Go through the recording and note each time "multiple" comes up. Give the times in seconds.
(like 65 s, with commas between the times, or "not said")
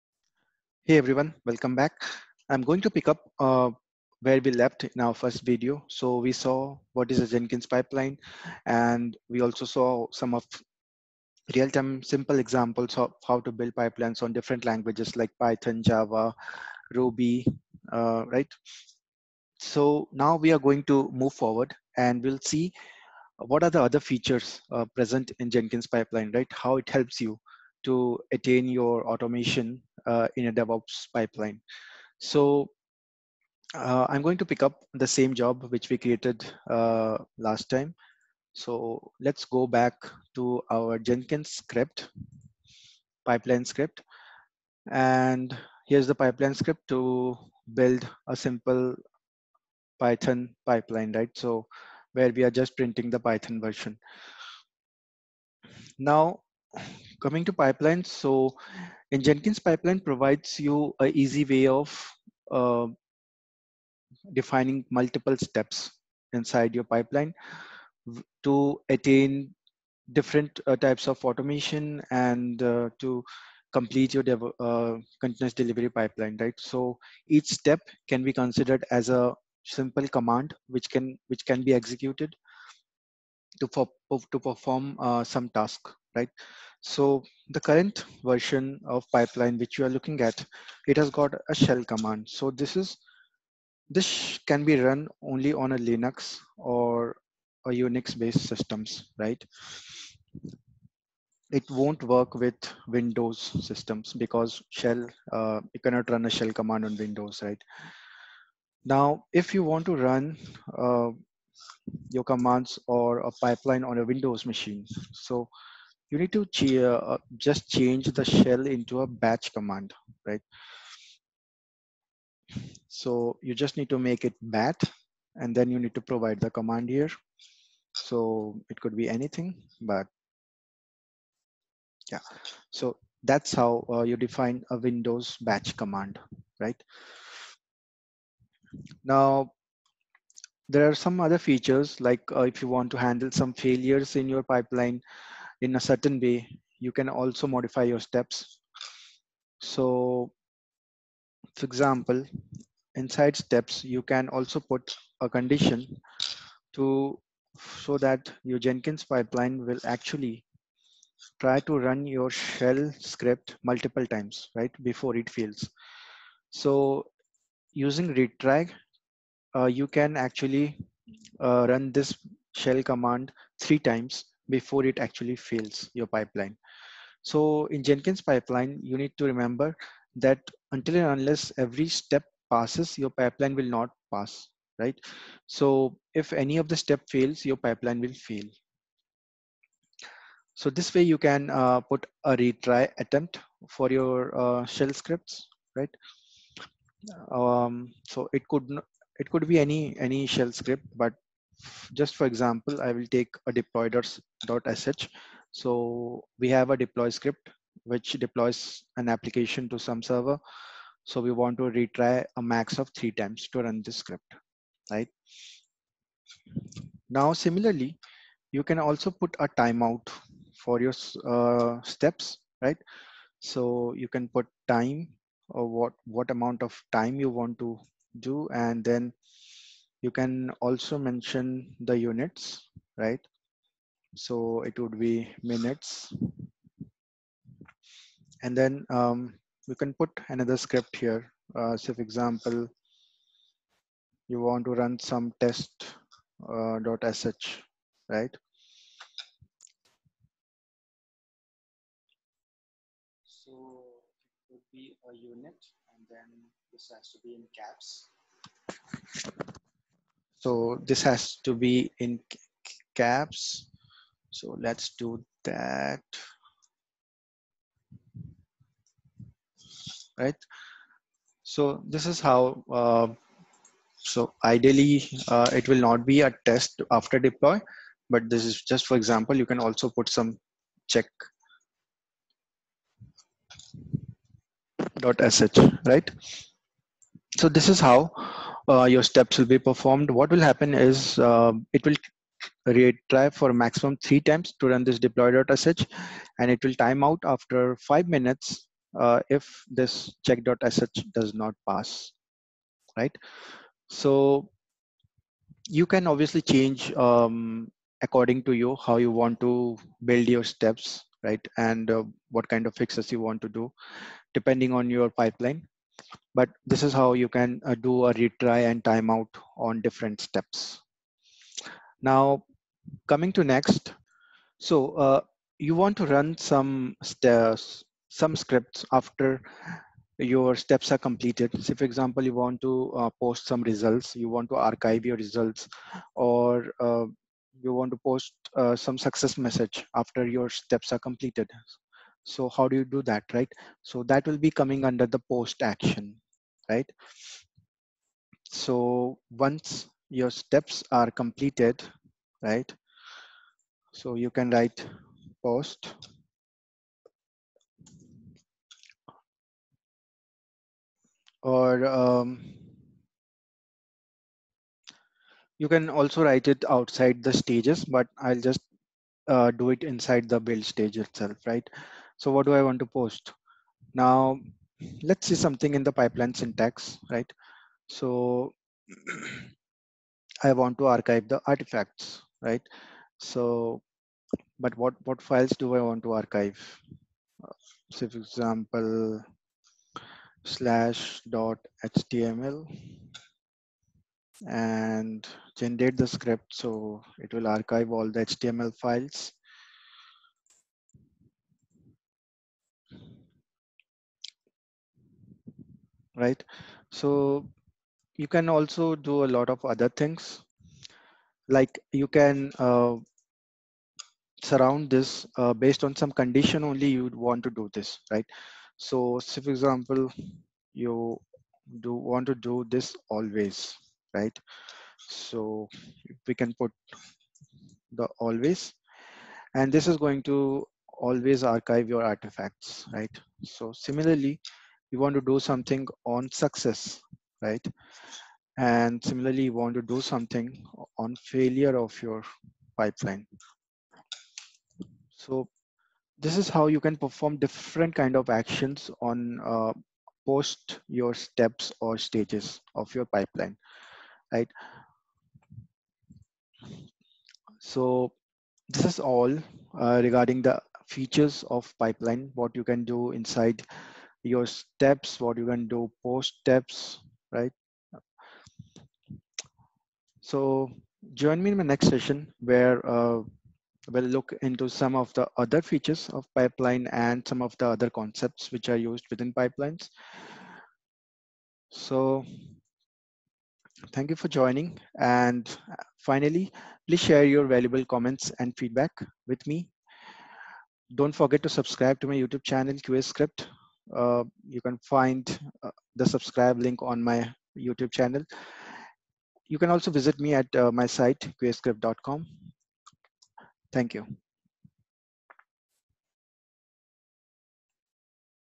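64 s, 163 s.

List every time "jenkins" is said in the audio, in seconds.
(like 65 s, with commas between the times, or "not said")
7 s, 25 s, 40 s, 59 s, 158 s, 177 s.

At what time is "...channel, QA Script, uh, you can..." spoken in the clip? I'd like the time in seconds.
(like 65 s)
492 s.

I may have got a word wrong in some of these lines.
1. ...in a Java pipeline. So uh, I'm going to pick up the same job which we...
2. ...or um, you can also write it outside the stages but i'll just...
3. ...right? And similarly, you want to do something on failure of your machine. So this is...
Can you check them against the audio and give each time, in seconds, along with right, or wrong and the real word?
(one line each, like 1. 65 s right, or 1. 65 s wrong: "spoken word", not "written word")
1. 30 s wrong: "DevOps", not "Java"
2. 361 s right
3. 437 s wrong: "pipeline", not "machine".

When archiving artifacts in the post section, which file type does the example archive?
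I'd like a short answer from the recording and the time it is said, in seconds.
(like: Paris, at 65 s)
HTML files, at 398 s.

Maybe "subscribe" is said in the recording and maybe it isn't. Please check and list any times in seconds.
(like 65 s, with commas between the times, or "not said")
491 s, 496 s.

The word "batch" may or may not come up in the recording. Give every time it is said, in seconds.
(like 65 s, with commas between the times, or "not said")
119 s, 135 s.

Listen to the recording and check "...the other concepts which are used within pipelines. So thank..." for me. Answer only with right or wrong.
right.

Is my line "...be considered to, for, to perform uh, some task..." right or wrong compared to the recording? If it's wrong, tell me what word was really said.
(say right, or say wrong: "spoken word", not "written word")
wrong: "executed", not "considered".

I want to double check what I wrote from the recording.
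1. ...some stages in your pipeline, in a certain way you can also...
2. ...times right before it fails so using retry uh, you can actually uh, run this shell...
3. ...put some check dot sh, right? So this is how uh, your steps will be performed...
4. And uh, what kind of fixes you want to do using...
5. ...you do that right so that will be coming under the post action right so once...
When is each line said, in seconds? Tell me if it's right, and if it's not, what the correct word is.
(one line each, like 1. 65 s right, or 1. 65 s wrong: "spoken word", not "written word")
1. 143 s wrong: "failures", not "stages"
2. 164 s right
3. 279 s right
4. 311 s wrong: "depending", not "using"
5. 342 s right.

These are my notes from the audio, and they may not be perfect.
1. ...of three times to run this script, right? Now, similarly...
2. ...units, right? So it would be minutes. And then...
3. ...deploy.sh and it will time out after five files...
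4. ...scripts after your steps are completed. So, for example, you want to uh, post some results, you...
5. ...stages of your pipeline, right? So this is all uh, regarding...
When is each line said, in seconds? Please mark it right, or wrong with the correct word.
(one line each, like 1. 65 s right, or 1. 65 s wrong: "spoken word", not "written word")
1. 212 s right
2. 231 s right
3. 294 s wrong: "minutes", not "files"
4. 328 s right
5. 451 s right.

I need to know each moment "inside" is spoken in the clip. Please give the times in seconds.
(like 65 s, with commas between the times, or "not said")
66 s, 152 s, 369 s, 463 s.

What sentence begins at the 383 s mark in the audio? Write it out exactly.
So, but what, what files do I want to archive?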